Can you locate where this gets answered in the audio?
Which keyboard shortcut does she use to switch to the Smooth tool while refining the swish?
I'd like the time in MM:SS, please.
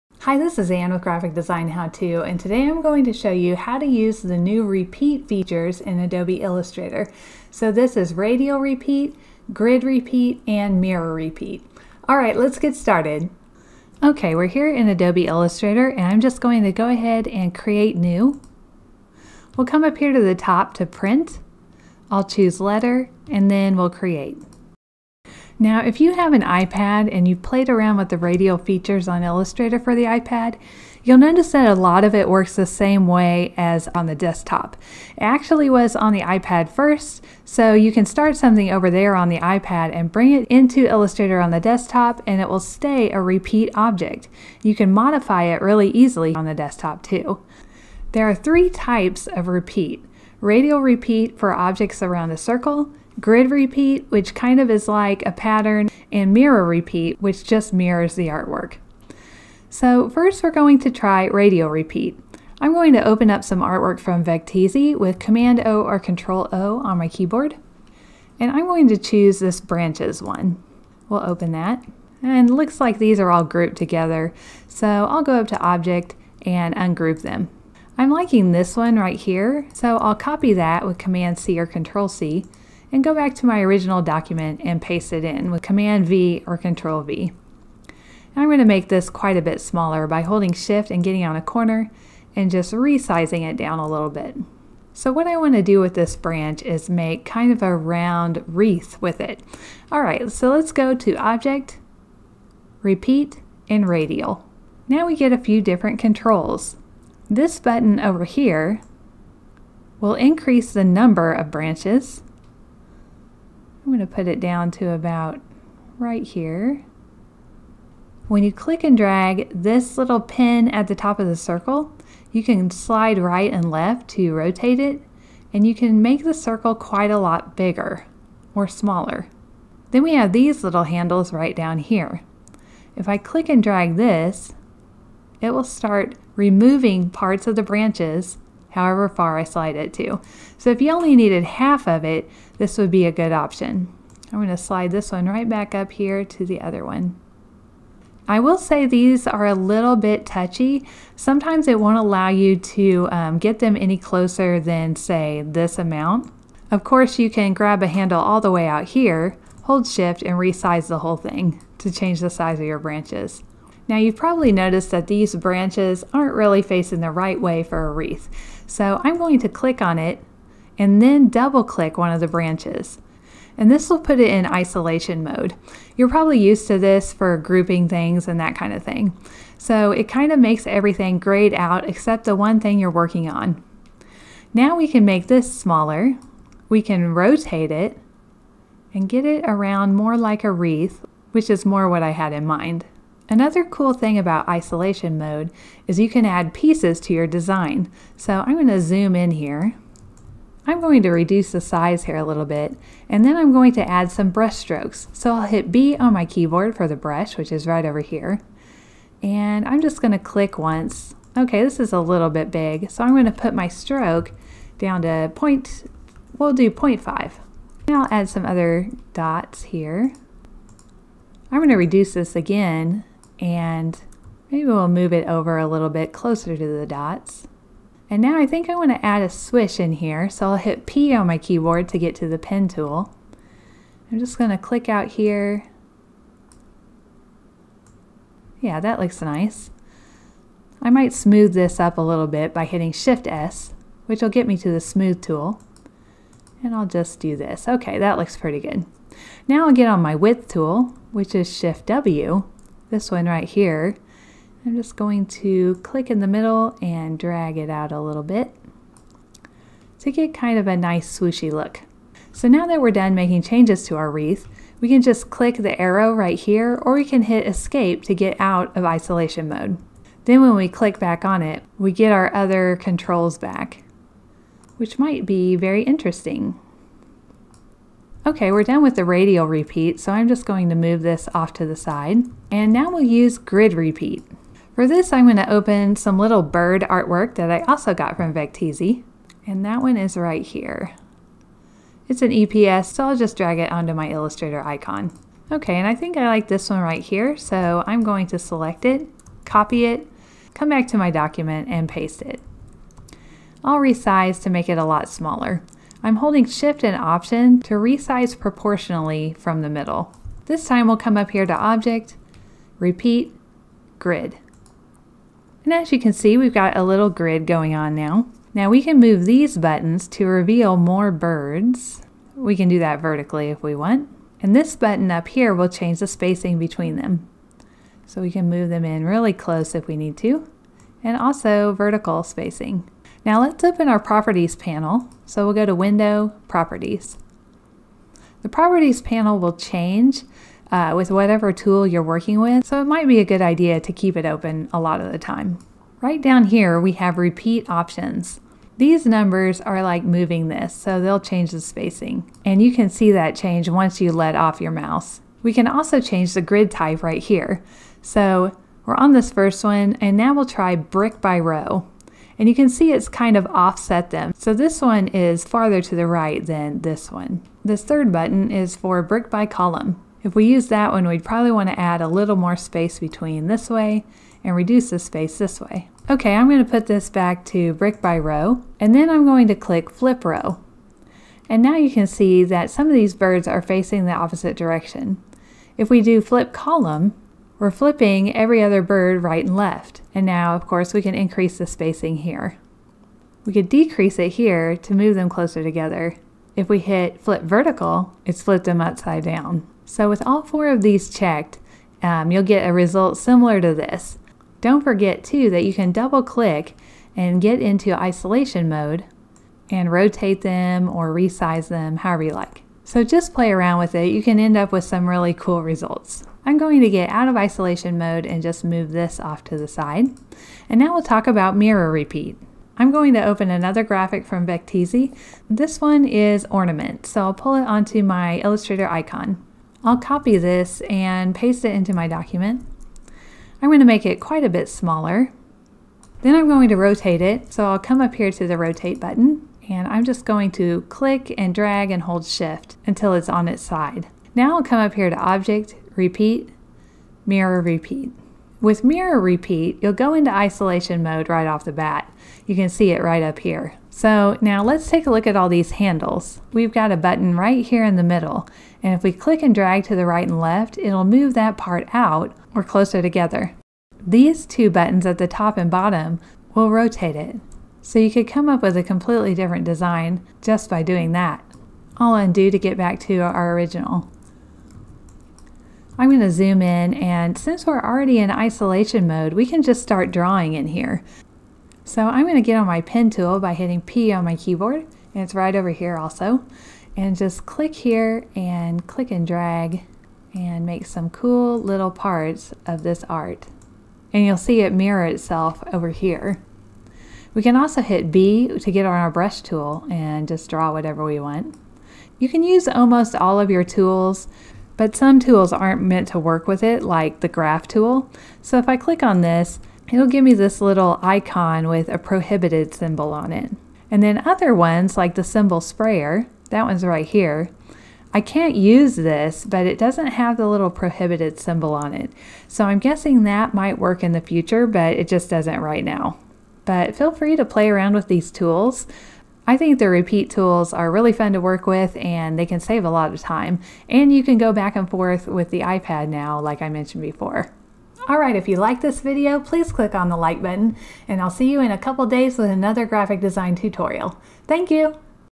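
04:02.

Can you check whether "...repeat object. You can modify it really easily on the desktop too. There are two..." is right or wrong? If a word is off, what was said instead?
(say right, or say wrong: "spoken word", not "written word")
wrong: "three", not "two".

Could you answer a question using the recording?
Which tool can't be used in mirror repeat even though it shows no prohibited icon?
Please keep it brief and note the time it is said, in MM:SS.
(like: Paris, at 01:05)
symbol sprayer, at 08:35.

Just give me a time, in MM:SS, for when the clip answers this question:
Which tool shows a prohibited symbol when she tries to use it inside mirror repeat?
08:27.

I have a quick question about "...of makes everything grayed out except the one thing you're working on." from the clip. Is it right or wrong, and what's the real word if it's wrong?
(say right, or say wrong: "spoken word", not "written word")
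right.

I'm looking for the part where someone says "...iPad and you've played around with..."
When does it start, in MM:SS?
00:26.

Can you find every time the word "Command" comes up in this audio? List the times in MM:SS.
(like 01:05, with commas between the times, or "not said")
01:05, 01:20, 01:25.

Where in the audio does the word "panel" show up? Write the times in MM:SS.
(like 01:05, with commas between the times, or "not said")
05:34, 05:39.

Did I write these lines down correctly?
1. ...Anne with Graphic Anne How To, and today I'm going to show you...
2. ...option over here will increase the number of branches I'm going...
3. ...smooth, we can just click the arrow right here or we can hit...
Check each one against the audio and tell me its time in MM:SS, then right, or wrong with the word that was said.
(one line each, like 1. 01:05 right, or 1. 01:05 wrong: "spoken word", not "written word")
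1. 00:00 wrong: "Design", not "Anne"
2. 01:47 wrong: "button", not "option"
3. 04:24 wrong: "wreath", not "smooth".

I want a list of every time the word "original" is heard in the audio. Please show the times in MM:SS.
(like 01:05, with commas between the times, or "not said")
01:23, 07:53.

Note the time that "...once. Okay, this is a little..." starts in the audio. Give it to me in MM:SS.
03:30.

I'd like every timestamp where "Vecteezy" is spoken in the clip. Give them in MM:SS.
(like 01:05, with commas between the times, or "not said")
01:04, 04:48, 07:04.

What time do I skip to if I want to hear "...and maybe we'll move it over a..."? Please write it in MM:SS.
03:43.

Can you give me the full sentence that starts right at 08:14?
And you'll see it mirror itself over here.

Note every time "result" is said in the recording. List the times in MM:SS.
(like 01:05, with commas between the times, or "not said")
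06:42, 06:55.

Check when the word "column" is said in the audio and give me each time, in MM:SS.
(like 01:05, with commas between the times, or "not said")
06:09, 06:26.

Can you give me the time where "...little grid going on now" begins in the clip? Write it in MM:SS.
05:16.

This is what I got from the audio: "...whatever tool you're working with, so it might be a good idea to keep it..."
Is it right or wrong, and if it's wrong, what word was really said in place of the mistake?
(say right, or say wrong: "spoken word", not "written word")
right.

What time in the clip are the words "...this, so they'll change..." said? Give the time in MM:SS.
05:50.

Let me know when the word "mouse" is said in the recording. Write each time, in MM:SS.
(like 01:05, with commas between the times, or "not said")
05:54.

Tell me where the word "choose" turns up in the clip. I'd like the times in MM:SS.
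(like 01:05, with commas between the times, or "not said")
00:22, 01:08.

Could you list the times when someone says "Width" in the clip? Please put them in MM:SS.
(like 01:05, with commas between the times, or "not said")
04:10.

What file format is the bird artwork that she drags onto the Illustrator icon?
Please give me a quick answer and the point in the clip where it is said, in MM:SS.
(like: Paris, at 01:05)
EPS, at 04:52.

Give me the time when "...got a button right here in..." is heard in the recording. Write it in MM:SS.
07:36.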